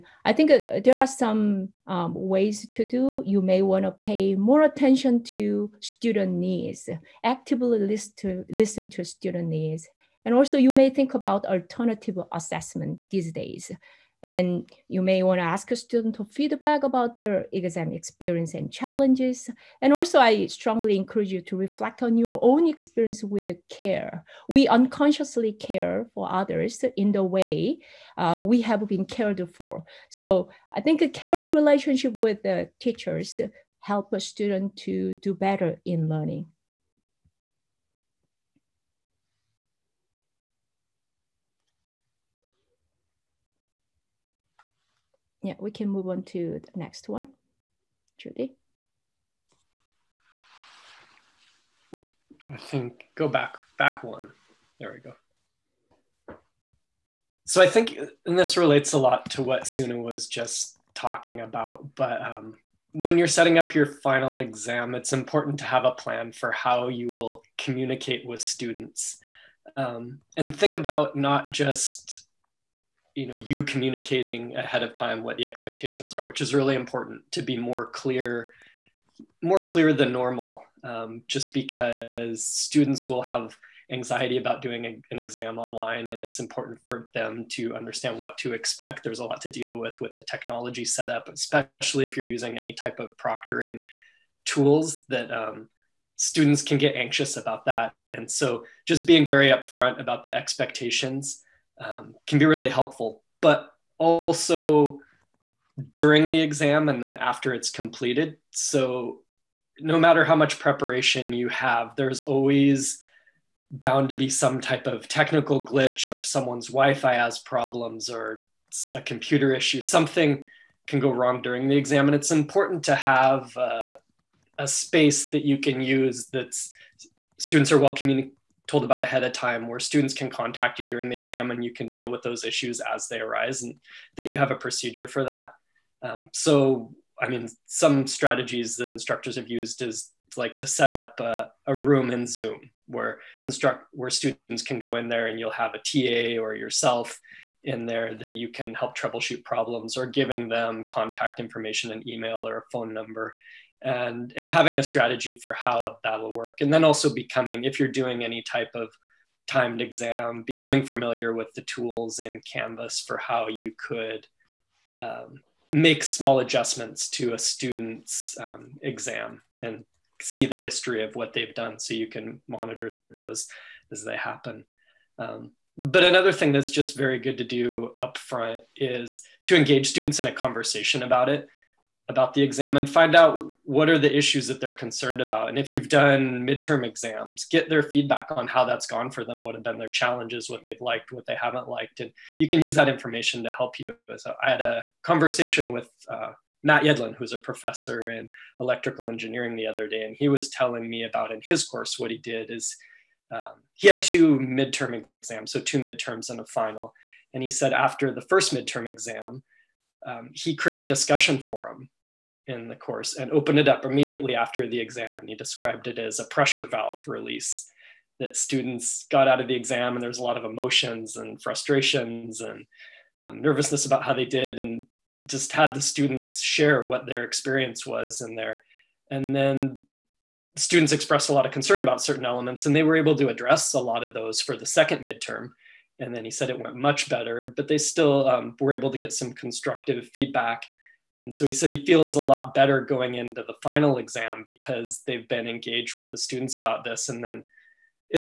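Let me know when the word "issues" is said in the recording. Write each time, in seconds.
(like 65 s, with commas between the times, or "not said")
119 s, 132 s, 184 s.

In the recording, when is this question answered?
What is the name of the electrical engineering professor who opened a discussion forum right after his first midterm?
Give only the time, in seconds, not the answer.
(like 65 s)
196 s.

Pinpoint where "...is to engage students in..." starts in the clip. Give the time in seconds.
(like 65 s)
178 s.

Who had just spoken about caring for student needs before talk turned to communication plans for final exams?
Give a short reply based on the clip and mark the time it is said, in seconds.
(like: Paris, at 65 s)
Suna, at 59 s.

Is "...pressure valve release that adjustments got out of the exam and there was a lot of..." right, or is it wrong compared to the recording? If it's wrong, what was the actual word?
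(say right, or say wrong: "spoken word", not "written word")
wrong: "students", not "adjustments".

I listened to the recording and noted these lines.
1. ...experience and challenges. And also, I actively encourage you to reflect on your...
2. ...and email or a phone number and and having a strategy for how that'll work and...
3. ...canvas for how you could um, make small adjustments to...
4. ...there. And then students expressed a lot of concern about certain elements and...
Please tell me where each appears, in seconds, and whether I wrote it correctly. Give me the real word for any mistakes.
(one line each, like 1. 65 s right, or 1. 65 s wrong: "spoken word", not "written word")
1. 17 s wrong: "strongly", not "actively"
2. 151 s right
3. 162 s right
4. 228 s right.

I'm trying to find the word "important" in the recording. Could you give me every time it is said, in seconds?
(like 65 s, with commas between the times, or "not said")
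65 s, 76 s, 86 s, 122 s.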